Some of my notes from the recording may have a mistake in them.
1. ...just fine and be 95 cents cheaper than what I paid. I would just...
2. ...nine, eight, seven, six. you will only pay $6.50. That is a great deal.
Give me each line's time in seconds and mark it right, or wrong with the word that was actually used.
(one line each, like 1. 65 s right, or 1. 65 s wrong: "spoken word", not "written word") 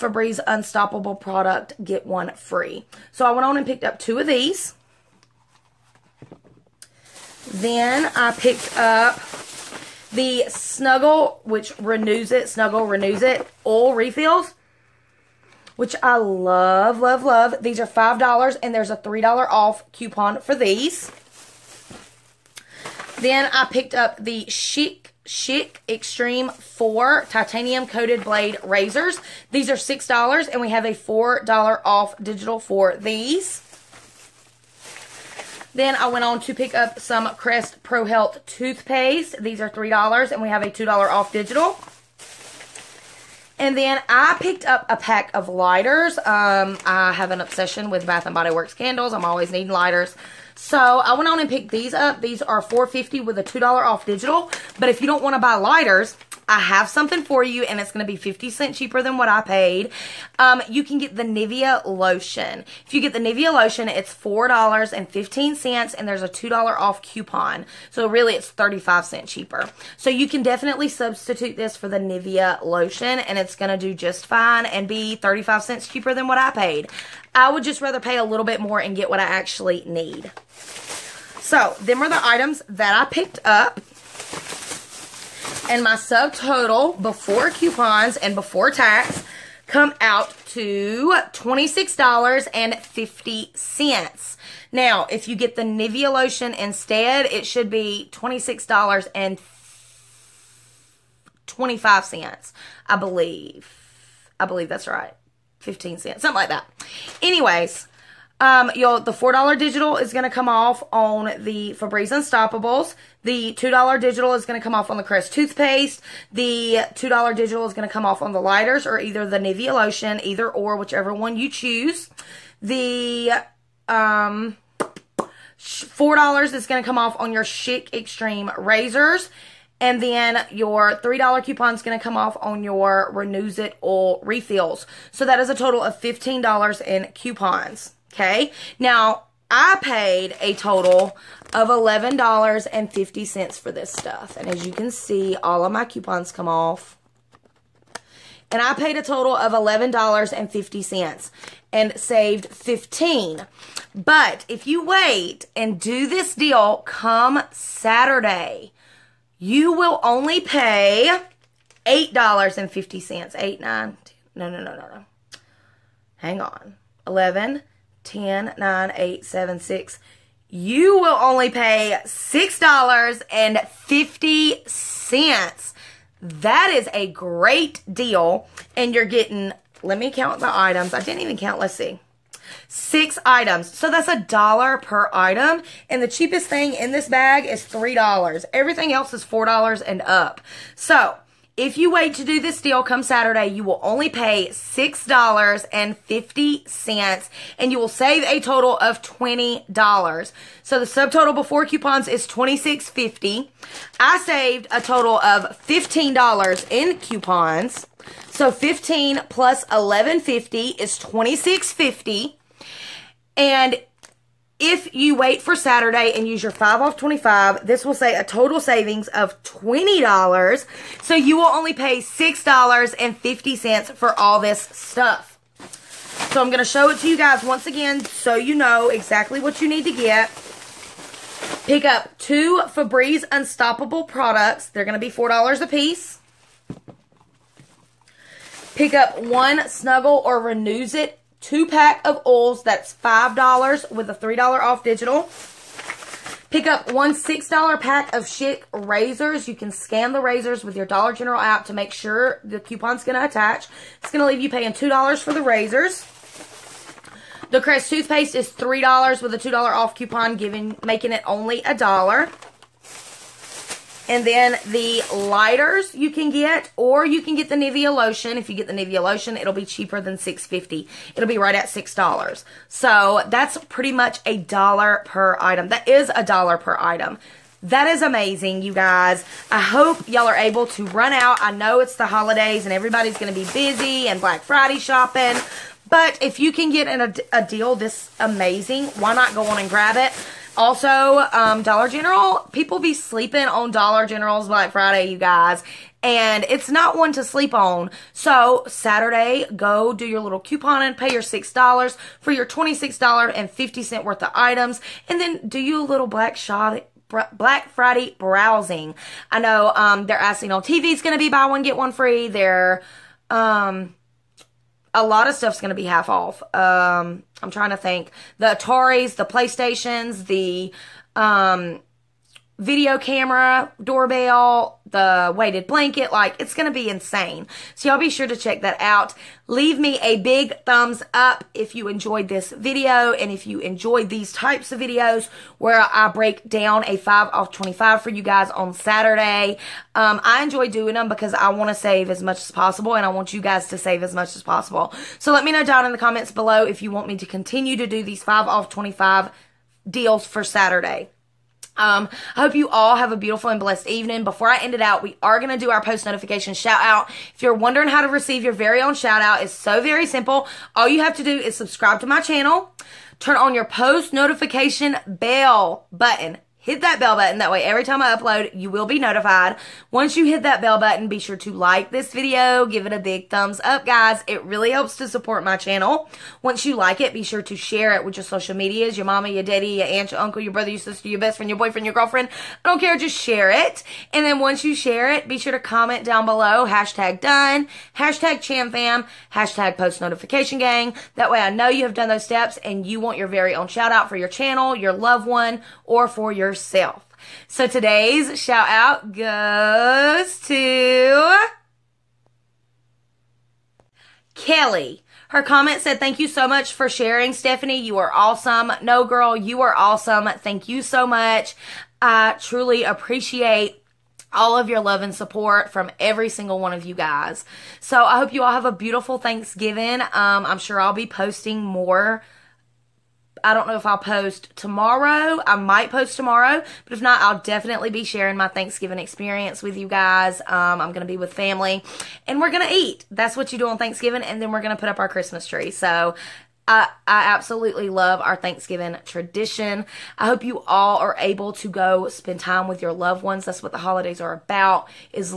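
1. 73 s wrong: "35", not "95"
2. 168 s right.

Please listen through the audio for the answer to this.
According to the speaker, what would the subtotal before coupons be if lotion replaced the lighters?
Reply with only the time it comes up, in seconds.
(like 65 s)
98 s.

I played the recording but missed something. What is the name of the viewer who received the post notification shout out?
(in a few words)
Kelly.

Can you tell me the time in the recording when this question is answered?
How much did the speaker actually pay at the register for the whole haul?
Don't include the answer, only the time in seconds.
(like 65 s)
139 s.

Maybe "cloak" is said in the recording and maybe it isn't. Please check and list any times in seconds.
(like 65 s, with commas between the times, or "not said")
not said.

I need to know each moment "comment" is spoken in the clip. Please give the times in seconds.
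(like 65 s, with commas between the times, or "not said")
345 s, 385 s, 405 s.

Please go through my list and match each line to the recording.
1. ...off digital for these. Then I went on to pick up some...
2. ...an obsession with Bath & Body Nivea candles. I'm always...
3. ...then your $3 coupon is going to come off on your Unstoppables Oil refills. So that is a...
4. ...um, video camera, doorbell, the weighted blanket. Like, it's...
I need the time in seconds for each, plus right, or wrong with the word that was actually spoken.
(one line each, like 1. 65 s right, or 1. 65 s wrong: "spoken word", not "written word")
1. 31 s right
2. 47 s wrong: "Works", not "Nivea"
3. 130 s wrong: "Renuzit", not "Unstoppables"
4. 321 s right.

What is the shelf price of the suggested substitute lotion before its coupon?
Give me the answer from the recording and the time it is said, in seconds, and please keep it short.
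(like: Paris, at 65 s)
$4.15, at 63 s.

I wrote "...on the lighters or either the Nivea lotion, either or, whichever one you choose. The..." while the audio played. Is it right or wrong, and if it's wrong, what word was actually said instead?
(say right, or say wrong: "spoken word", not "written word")
right.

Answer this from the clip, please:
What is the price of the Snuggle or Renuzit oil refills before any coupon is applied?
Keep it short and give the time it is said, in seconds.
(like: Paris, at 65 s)
$5, at 17 s.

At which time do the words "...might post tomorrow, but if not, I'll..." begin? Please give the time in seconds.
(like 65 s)
425 s.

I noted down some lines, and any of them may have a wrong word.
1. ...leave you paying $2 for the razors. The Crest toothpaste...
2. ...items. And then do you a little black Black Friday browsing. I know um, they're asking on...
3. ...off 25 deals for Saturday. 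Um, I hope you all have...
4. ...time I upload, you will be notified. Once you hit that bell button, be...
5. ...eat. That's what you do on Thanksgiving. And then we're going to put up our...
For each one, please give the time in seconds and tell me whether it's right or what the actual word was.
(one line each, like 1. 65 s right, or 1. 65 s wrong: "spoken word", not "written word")
1. 254 s right
2. 304 s right
3. 348 s right
4. 367 s right
5. 432 s right.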